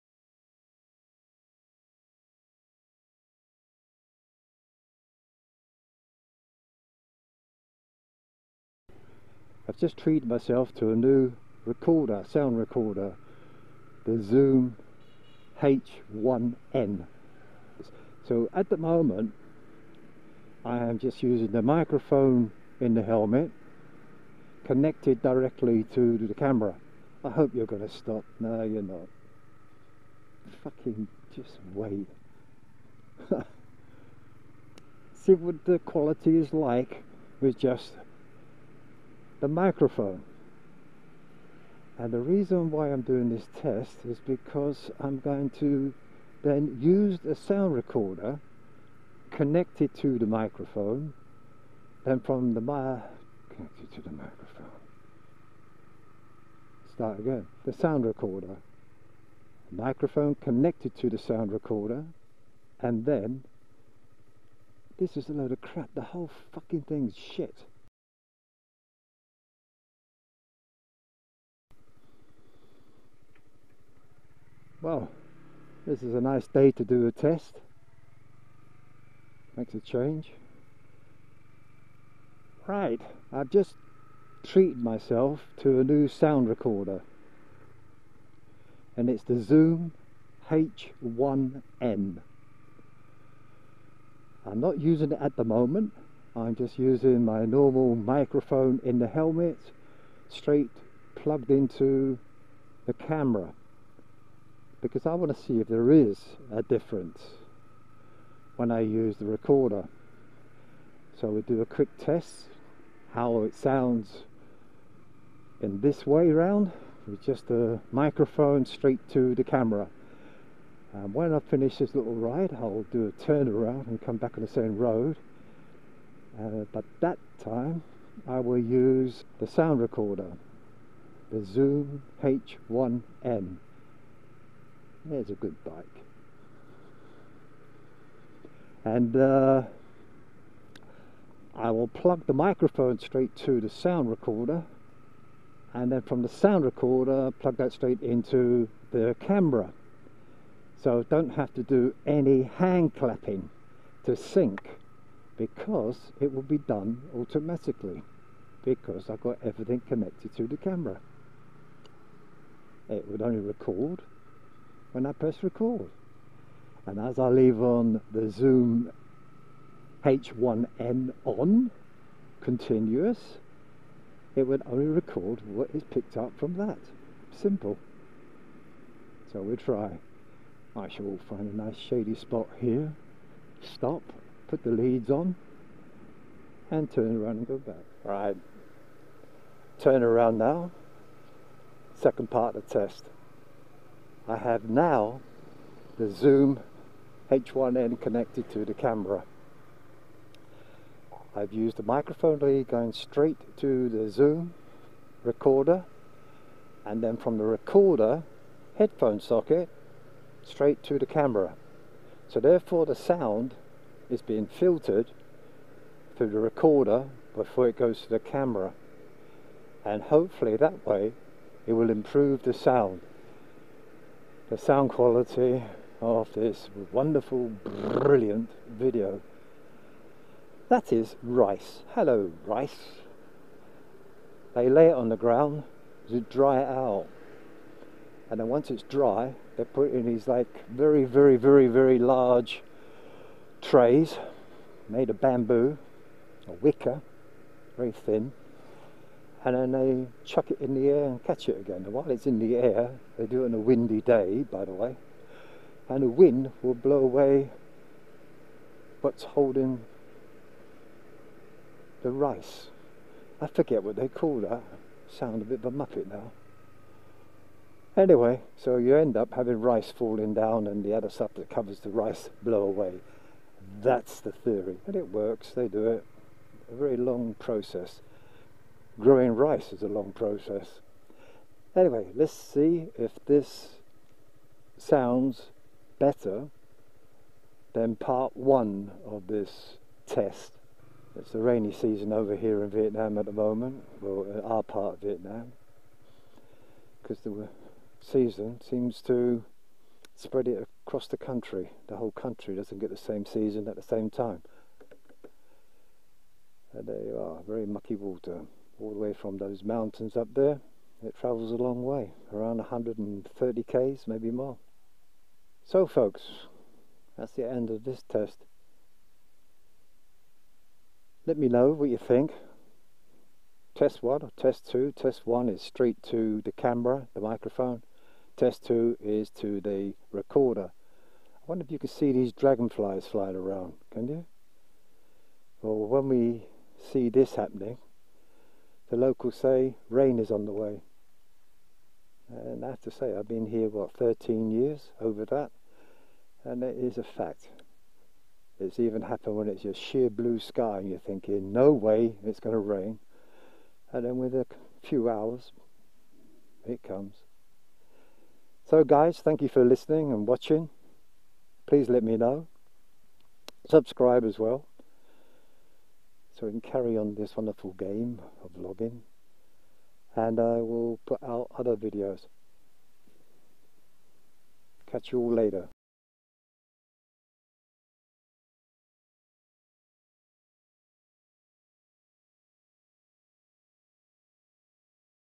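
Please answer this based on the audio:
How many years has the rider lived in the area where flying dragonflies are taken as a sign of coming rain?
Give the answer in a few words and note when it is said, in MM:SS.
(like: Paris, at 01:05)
13, at 05:43.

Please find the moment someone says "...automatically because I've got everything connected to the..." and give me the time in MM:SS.
02:37.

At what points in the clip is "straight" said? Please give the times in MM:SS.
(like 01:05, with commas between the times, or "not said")
01:40, 01:58, 02:22, 02:27, 03:22, 03:30, 05:25.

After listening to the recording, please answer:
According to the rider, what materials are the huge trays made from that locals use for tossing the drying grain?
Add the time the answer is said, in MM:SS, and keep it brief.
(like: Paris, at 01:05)
bamboo, or wicker, at 04:05.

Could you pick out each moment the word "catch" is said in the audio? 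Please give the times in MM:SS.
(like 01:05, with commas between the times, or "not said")
04:11, 06:14.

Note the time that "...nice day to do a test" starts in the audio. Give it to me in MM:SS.
01:16.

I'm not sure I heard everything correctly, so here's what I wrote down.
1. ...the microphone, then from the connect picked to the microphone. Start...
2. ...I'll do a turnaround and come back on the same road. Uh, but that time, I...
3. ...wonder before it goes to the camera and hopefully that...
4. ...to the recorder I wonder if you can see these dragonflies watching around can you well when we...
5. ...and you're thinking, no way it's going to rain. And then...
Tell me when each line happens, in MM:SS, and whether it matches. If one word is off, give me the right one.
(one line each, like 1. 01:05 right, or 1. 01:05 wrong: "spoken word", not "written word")
1. 00:50 wrong: "connected", not "picked"
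2. 02:02 right
3. 03:36 wrong: "recorder", not "wonder"
4. 05:29 wrong: "flying", not "watching"
5. 05:50 right.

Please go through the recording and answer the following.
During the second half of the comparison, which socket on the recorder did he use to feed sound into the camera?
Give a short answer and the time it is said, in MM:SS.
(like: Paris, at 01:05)
headphone socket, at 03:28.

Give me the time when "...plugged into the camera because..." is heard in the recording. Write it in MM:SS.
01:41.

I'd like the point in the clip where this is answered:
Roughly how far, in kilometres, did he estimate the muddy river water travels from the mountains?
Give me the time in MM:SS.
05:12.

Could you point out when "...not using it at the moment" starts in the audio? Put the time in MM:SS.
01:34.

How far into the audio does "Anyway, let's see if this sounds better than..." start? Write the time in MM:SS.
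04:41.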